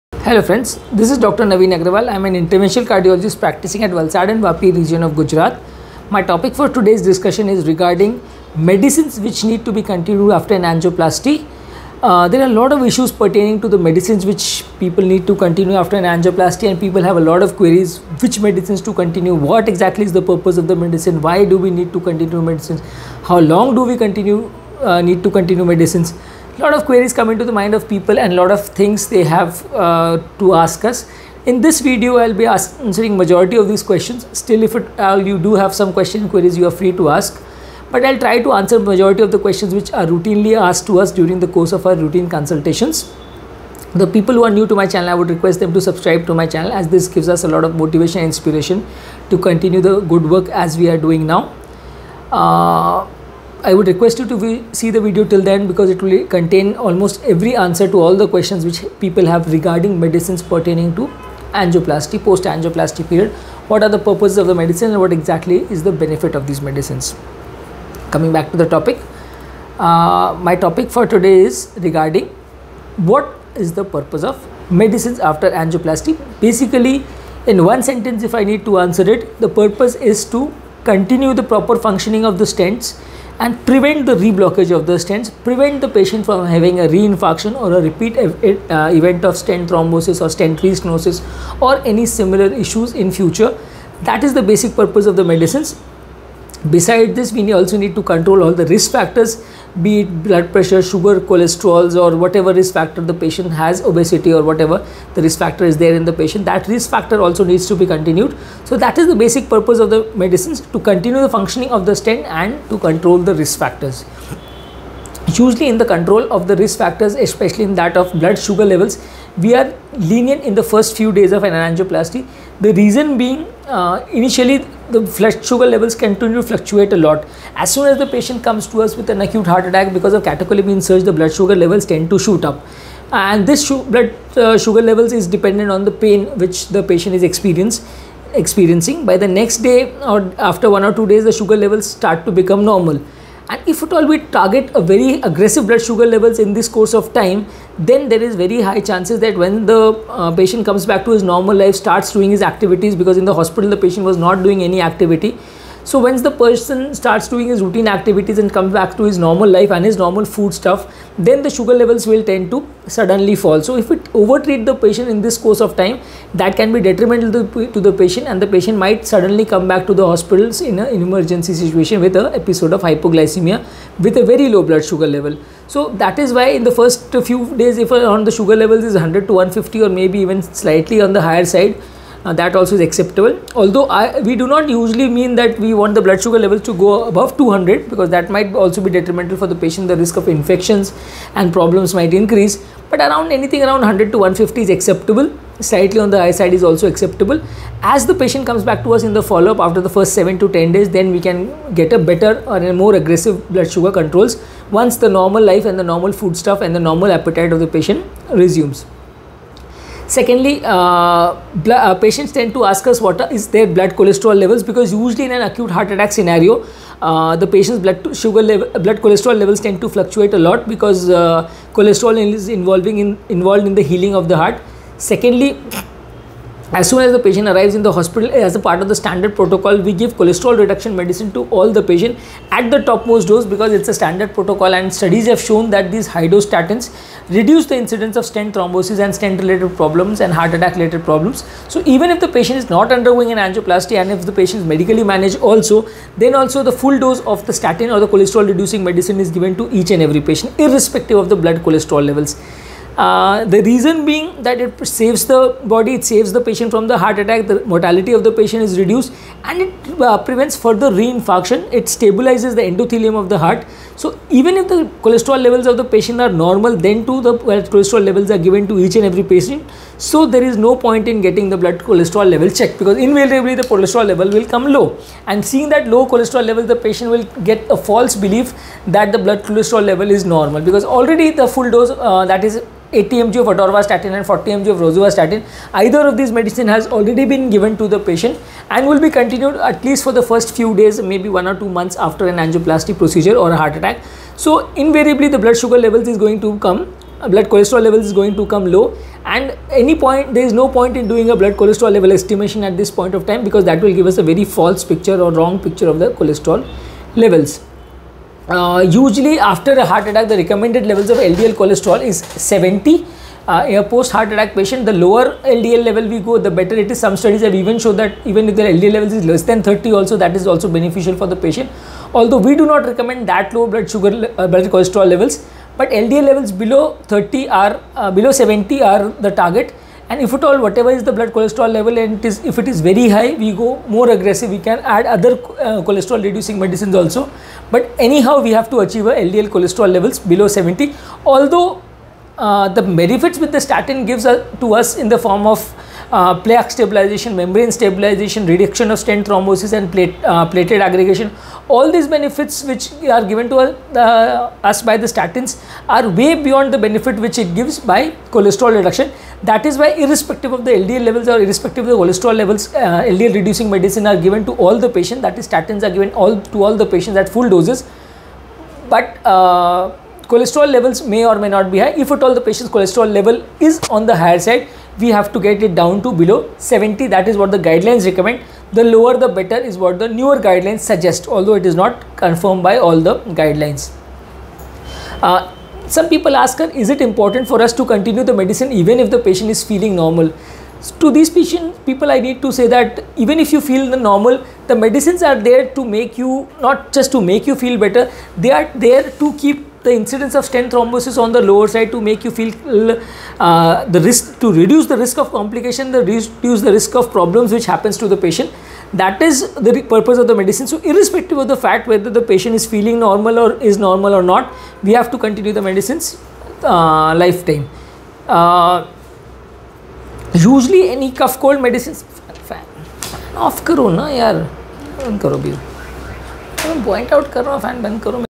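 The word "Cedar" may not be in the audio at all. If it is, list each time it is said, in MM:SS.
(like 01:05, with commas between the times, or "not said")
not said.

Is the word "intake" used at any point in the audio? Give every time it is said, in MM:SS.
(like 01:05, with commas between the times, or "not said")
not said.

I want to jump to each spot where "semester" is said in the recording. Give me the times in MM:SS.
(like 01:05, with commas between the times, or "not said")
not said.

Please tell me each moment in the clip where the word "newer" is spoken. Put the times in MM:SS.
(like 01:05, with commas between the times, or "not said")
06:20.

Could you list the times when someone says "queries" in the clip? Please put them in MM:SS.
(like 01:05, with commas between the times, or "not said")
00:17, 00:26, 00:36.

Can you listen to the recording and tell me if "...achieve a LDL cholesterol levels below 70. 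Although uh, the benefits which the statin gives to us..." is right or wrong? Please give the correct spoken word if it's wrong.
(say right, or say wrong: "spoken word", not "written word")
right.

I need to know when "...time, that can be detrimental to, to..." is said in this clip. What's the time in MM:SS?
02:45.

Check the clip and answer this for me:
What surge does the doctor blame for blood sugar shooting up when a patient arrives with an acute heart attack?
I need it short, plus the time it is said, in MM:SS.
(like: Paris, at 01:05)
Catecholamine surge, at 02:10.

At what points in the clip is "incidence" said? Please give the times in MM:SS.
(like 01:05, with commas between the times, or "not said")
03:57, 06:39.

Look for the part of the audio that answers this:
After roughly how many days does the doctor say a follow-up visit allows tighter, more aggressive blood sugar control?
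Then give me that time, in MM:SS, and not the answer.
03:20.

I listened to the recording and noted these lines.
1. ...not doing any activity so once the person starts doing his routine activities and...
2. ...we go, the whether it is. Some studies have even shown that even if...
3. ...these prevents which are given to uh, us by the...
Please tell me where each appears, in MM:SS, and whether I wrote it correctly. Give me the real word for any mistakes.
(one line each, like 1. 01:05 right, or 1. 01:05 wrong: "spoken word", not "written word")
1. 02:34 right
2. 05:16 wrong: "better", not "whether"
3. 05:51 wrong: "benefits", not "prevents".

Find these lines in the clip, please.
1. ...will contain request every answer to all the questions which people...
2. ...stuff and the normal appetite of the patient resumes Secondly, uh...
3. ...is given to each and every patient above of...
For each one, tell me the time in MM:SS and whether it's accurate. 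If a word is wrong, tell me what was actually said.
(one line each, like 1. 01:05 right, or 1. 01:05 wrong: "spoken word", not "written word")
1. 00:56 wrong: "almost", not "request"
2. 03:26 right
3. 04:09 wrong: "irrespective", not "above".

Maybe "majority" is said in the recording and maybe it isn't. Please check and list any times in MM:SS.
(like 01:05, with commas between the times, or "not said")
00:33, 00:38.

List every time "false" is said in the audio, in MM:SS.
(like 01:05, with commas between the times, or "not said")
04:37, 05:04.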